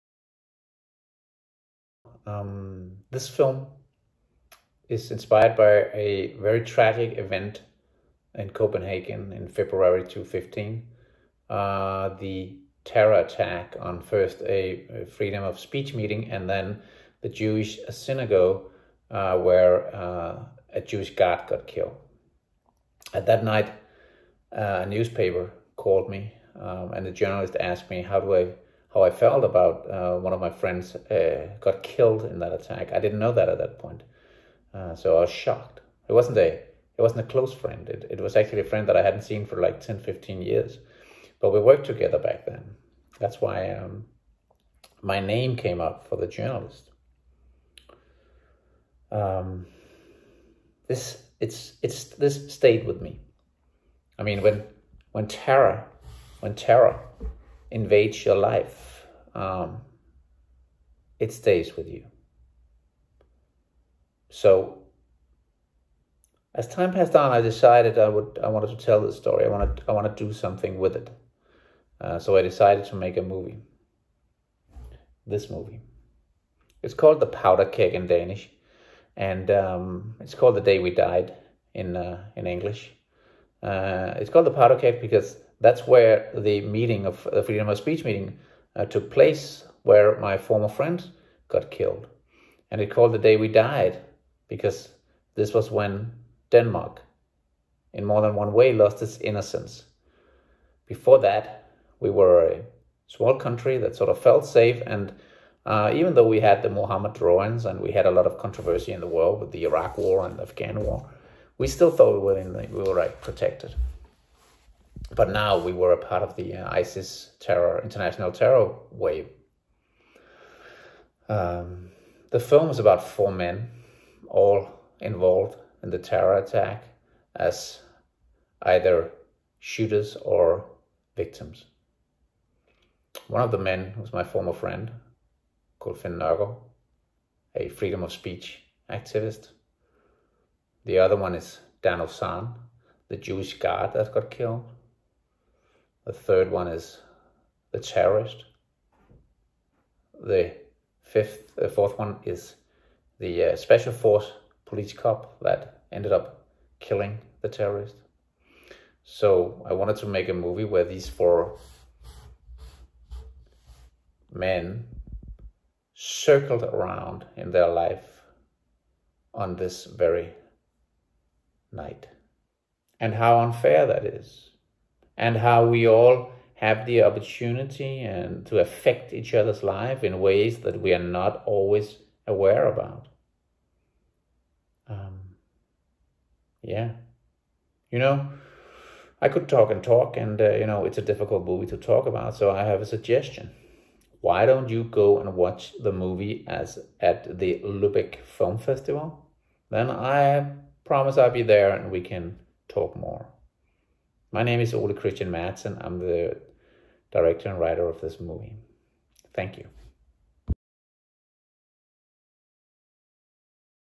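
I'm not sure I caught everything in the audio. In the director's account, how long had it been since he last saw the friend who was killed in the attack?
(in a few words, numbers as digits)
10-15 years.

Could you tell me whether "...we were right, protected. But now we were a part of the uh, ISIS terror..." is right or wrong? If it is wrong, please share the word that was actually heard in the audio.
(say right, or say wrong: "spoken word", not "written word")
right.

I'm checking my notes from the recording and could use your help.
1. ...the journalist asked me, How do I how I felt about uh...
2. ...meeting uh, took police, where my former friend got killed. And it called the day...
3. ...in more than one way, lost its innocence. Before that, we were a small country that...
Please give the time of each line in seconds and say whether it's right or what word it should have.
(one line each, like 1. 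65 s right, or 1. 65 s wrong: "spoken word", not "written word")
1. 27 s right
2. 88 s wrong: "place", not "police"
3. 97 s right.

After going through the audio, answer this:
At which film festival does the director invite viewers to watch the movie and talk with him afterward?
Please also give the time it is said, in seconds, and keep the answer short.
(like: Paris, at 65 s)
Lübeck Film Festival, at 197 s.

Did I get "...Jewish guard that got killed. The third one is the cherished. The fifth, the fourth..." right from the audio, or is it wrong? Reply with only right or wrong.
right.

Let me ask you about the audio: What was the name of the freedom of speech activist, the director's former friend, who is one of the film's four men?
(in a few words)
Finn Nørgaard.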